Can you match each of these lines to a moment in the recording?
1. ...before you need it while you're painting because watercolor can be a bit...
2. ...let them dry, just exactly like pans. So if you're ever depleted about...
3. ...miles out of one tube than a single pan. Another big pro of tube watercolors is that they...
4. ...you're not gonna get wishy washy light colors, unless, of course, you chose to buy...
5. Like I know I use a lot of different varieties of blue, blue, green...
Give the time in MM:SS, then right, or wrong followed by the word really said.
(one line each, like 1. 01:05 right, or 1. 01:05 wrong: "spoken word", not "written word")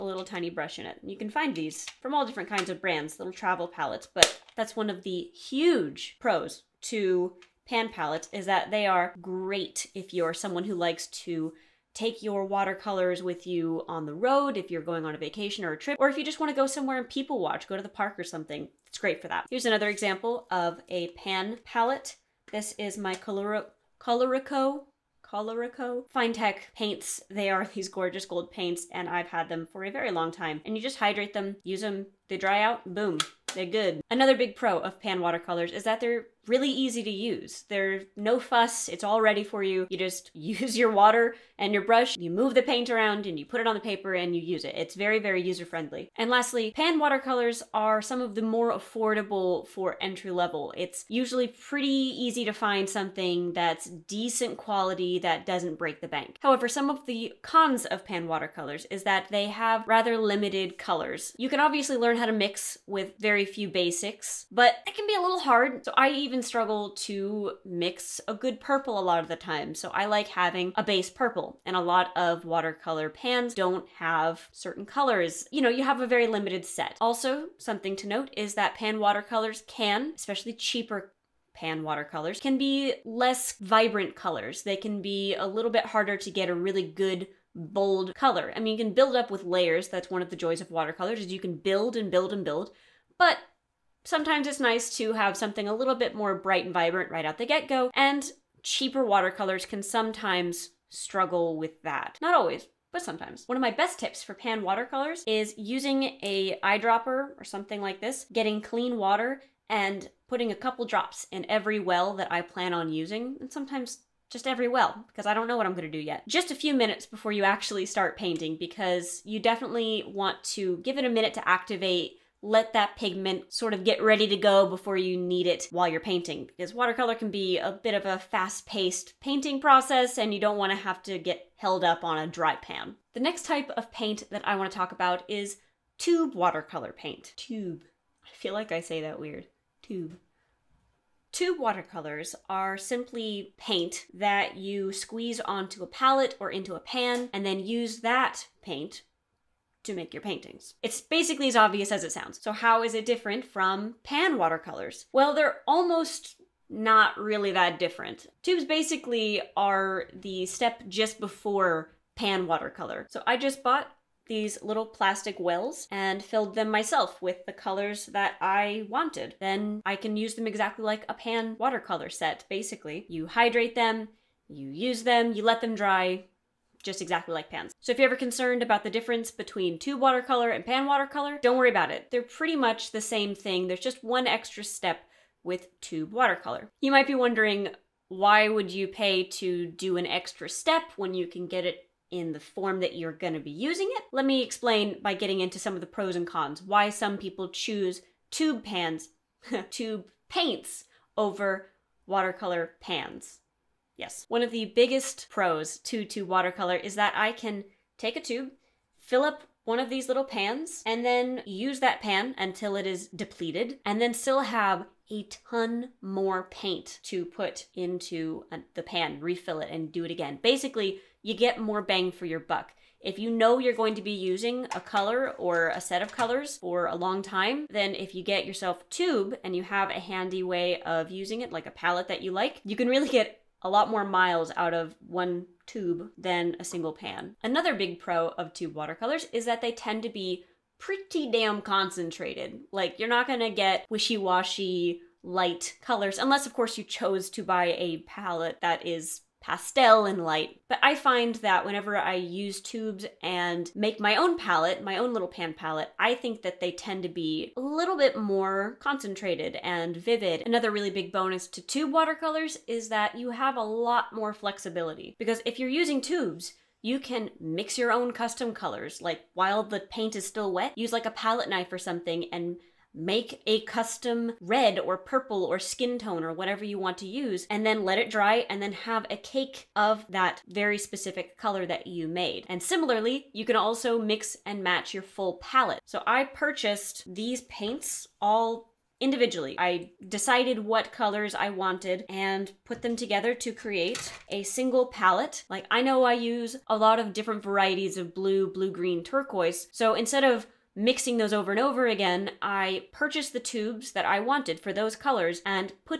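1. 02:04 right
2. 02:55 wrong: "concerned", not "depleted"
3. 03:54 right
4. 04:02 right
5. 04:55 right.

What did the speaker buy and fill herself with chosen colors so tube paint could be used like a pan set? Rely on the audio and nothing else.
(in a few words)
little plastic wells.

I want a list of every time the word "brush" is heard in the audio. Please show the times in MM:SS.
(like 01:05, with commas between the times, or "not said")
00:00, 00:41.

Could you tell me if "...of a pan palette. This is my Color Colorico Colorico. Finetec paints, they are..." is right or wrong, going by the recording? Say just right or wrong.
right.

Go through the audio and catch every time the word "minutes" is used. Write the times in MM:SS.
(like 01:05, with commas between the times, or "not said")
01:56, 02:01.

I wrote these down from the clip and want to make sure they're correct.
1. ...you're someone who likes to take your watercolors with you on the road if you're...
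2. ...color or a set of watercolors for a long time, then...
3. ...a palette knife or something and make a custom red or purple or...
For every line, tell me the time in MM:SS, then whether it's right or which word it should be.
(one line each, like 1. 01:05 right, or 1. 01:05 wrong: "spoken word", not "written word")
1. 00:10 right
2. 03:44 wrong: "colors", not "watercolors"
3. 04:31 right.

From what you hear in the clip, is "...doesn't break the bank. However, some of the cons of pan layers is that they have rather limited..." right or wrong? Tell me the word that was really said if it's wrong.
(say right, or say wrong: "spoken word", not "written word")
wrong: "watercolors", not "layers".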